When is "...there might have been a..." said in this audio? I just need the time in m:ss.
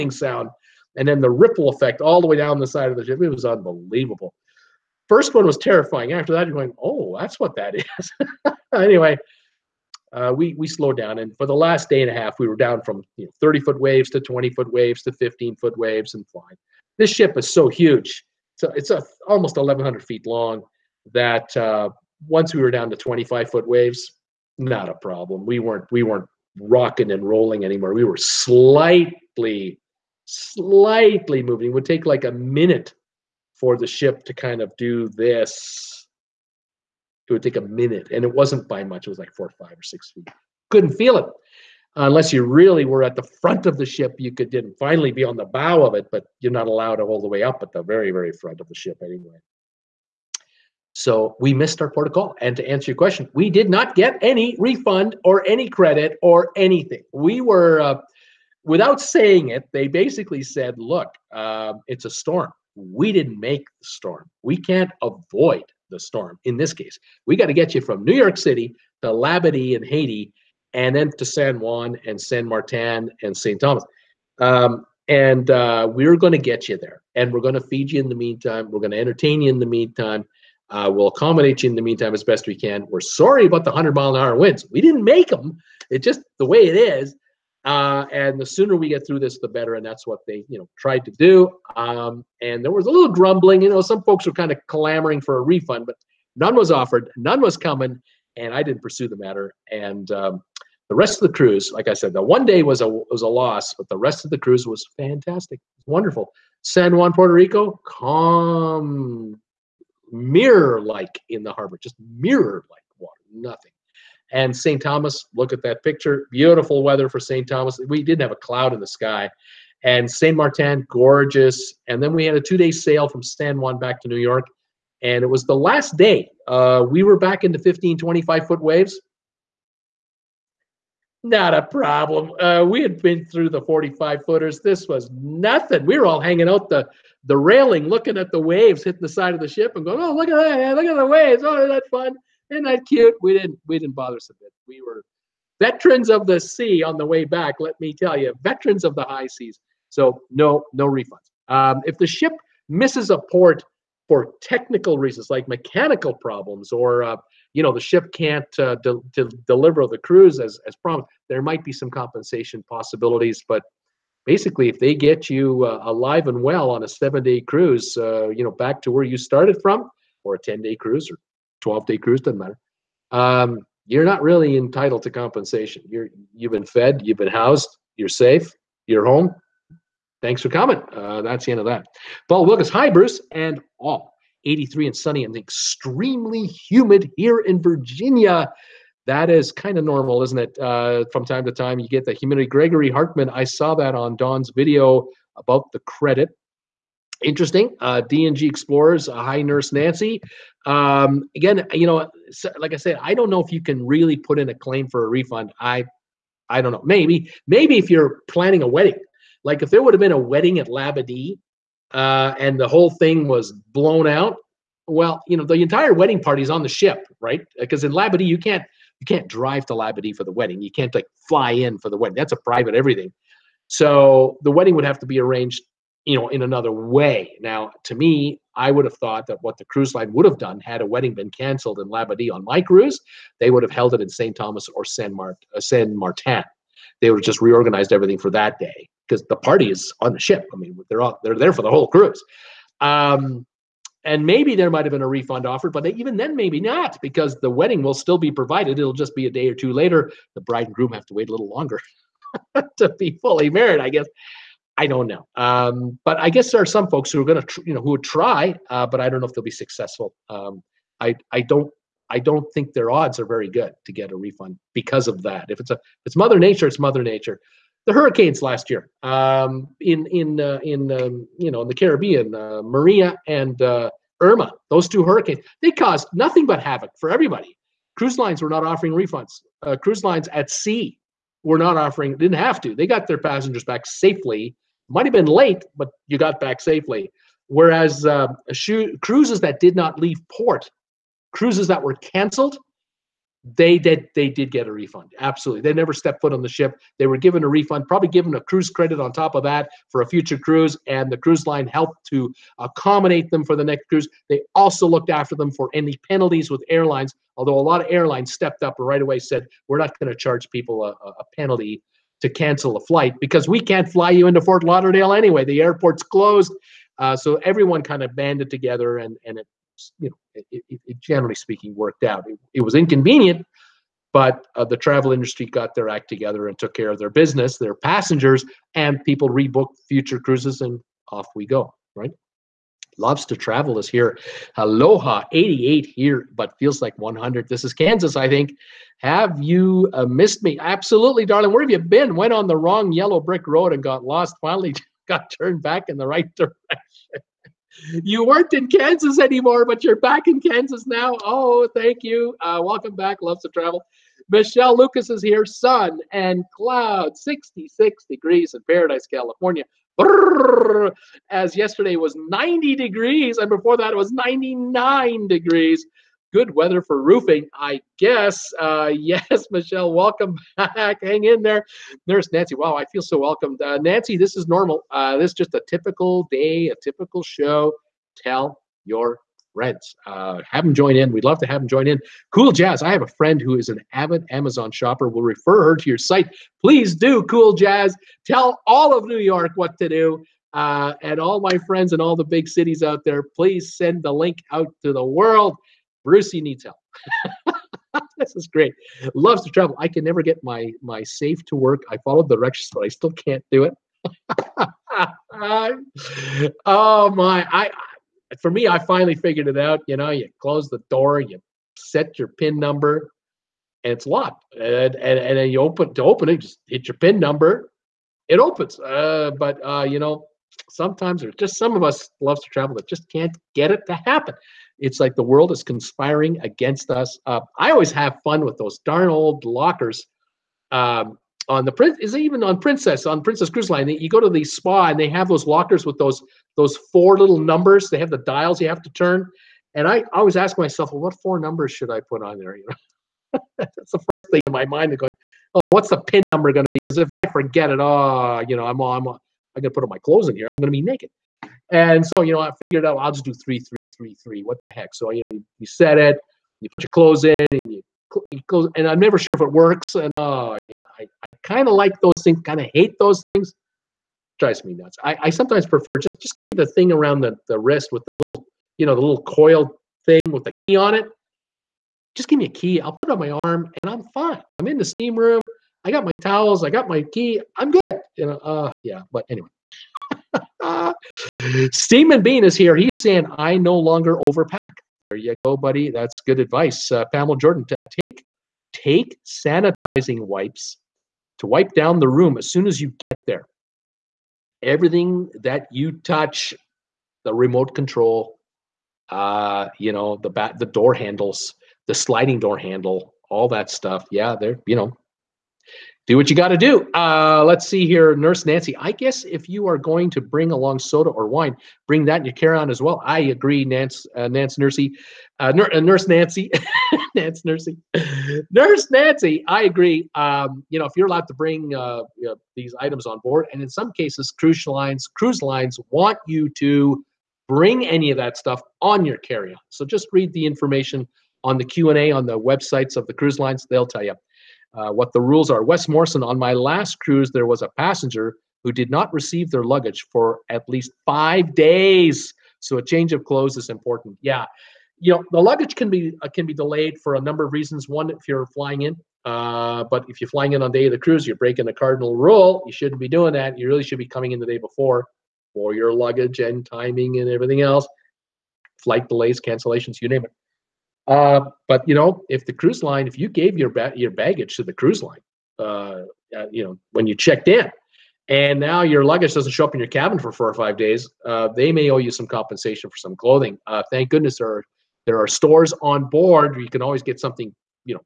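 4:04.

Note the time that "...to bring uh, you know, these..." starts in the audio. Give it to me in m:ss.
8:41.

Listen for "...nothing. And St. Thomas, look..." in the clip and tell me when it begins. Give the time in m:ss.
1:53.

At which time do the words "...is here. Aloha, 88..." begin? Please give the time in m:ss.
5:33.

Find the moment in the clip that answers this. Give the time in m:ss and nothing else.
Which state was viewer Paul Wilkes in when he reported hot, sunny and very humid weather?
3:07.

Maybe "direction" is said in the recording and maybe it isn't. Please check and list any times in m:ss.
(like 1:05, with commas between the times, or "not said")
5:46, 6:42.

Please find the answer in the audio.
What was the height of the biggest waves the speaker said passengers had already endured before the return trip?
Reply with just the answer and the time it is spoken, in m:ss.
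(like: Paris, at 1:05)
45 feet, at 2:13.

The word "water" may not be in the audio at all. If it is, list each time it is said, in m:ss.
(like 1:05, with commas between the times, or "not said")
1:52.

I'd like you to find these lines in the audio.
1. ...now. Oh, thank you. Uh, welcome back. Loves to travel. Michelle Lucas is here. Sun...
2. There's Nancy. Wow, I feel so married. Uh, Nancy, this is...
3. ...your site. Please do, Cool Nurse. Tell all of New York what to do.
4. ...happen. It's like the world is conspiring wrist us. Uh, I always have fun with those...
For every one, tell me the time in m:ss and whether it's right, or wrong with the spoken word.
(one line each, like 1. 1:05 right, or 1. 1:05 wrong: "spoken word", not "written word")
1. 5:50 right
2. 6:12 wrong: "welcomed", not "married"
3. 6:25 wrong: "Jazz", not "Nurse"
4. 7:04 wrong: "against", not "wrist".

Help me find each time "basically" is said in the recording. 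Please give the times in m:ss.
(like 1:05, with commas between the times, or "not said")
0:59, 2:44.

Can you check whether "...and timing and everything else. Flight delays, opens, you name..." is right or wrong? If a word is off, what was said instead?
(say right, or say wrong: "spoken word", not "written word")
wrong: "cancellations", not "opens".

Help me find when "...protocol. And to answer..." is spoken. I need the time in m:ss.
0:51.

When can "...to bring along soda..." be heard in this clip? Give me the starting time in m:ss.
8:30.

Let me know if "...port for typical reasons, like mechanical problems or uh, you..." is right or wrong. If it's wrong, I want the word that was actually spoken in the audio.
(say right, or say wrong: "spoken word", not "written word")
wrong: "technical", not "typical".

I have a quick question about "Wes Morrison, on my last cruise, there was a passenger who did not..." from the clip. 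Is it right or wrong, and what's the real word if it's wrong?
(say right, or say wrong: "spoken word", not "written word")
right.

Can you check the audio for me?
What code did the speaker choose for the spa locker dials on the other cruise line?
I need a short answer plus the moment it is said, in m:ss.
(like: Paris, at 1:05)
3333, at 7:33.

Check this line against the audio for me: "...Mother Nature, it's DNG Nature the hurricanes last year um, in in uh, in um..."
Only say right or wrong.
wrong.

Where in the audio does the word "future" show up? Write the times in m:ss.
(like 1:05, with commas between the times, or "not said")
5:00, 5:29.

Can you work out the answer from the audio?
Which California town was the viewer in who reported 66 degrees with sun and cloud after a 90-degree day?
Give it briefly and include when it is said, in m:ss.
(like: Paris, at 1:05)
Paradise, at 5:58.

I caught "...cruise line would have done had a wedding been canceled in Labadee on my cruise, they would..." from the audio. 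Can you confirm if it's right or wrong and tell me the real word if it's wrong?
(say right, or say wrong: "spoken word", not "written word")
right.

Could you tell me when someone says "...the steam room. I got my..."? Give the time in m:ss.
7:54.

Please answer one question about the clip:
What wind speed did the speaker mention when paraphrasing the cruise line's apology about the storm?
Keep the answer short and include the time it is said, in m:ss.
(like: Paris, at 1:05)
100 miles an hour, at 1:23.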